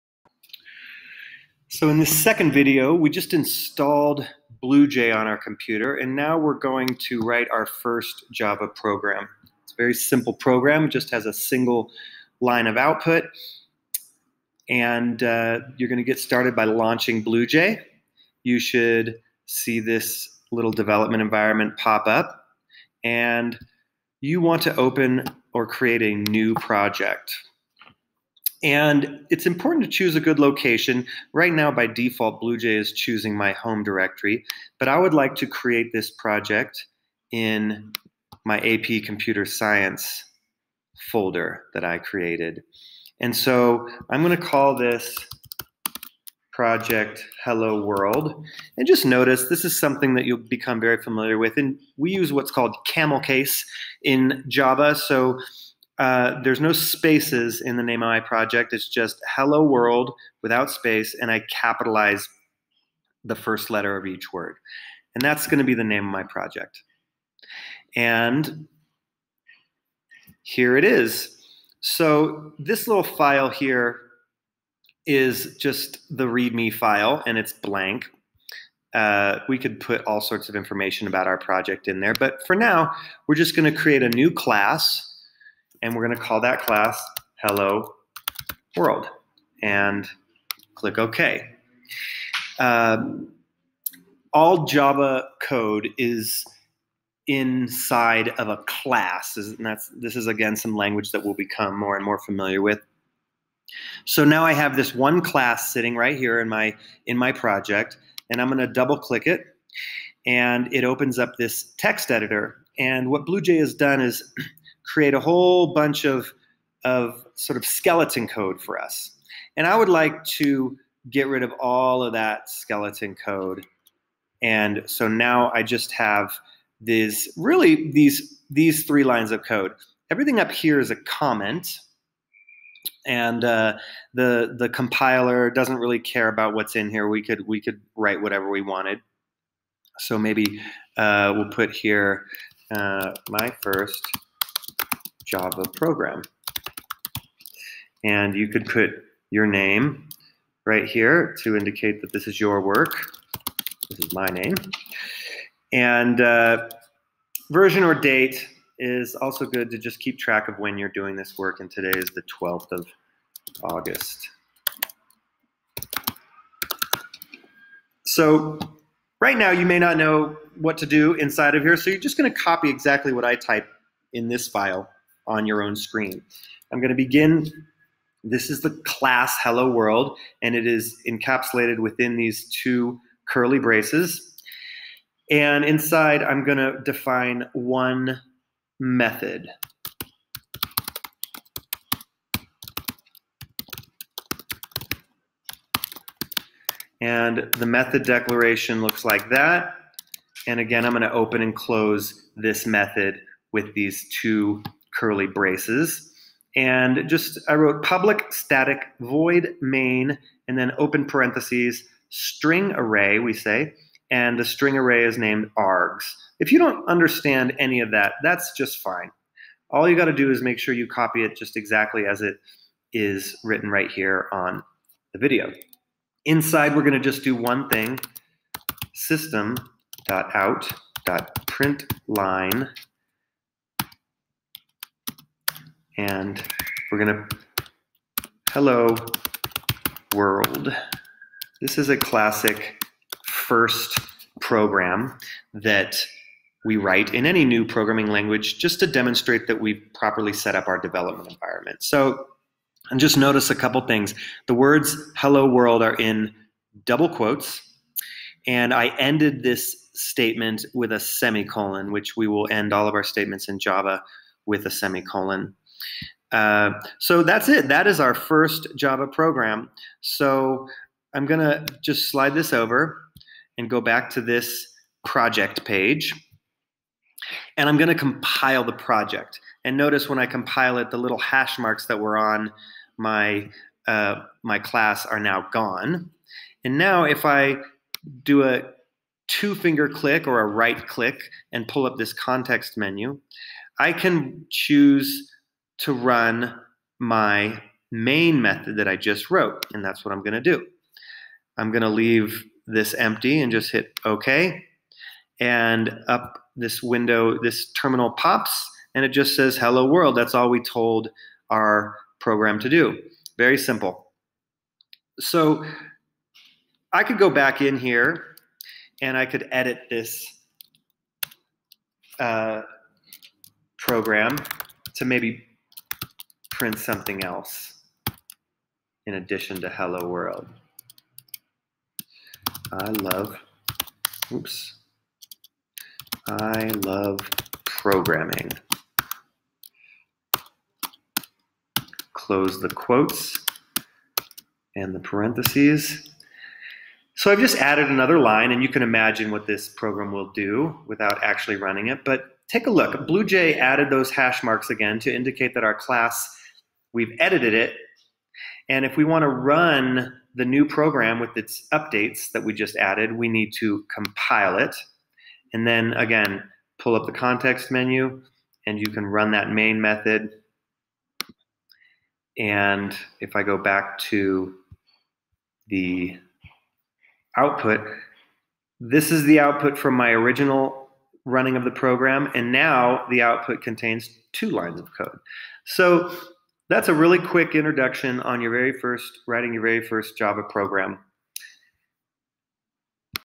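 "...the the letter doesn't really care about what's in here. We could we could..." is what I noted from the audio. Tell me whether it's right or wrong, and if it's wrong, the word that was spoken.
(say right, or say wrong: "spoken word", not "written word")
wrong: "compiler", not "letter".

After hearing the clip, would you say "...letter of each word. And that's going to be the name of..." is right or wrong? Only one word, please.
right.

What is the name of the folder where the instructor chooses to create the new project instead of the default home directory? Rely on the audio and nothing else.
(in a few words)
AP Computer Science.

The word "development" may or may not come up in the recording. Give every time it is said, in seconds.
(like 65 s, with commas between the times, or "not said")
20 s, 250 s.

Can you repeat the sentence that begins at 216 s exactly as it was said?
If you don't understand any of that, that's just fine.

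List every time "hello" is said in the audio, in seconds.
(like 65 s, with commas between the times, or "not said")
47 s, 59 s, 87 s, 179 s, 238 s, 255 s, 309 s, 329 s.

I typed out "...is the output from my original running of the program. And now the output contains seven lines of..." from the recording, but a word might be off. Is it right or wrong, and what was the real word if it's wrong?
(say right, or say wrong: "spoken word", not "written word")
wrong: "two", not "seven".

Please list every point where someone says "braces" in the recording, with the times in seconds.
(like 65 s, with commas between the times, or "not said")
183 s, 205 s.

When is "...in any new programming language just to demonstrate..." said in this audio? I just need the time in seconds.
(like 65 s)
247 s.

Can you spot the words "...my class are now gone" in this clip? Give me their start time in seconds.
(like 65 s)
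284 s.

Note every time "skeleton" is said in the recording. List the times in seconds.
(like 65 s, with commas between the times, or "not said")
117 s, 122 s.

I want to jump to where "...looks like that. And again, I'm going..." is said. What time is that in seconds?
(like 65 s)
198 s.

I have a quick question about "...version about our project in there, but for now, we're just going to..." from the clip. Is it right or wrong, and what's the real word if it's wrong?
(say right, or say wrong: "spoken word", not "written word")
wrong: "information", not "version".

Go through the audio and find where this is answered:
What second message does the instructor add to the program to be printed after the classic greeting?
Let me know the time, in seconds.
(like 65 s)
336 s.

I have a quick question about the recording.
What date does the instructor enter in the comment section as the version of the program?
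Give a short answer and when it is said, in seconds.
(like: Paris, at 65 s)
12th of August, at 162 s.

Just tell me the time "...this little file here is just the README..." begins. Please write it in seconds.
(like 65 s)
72 s.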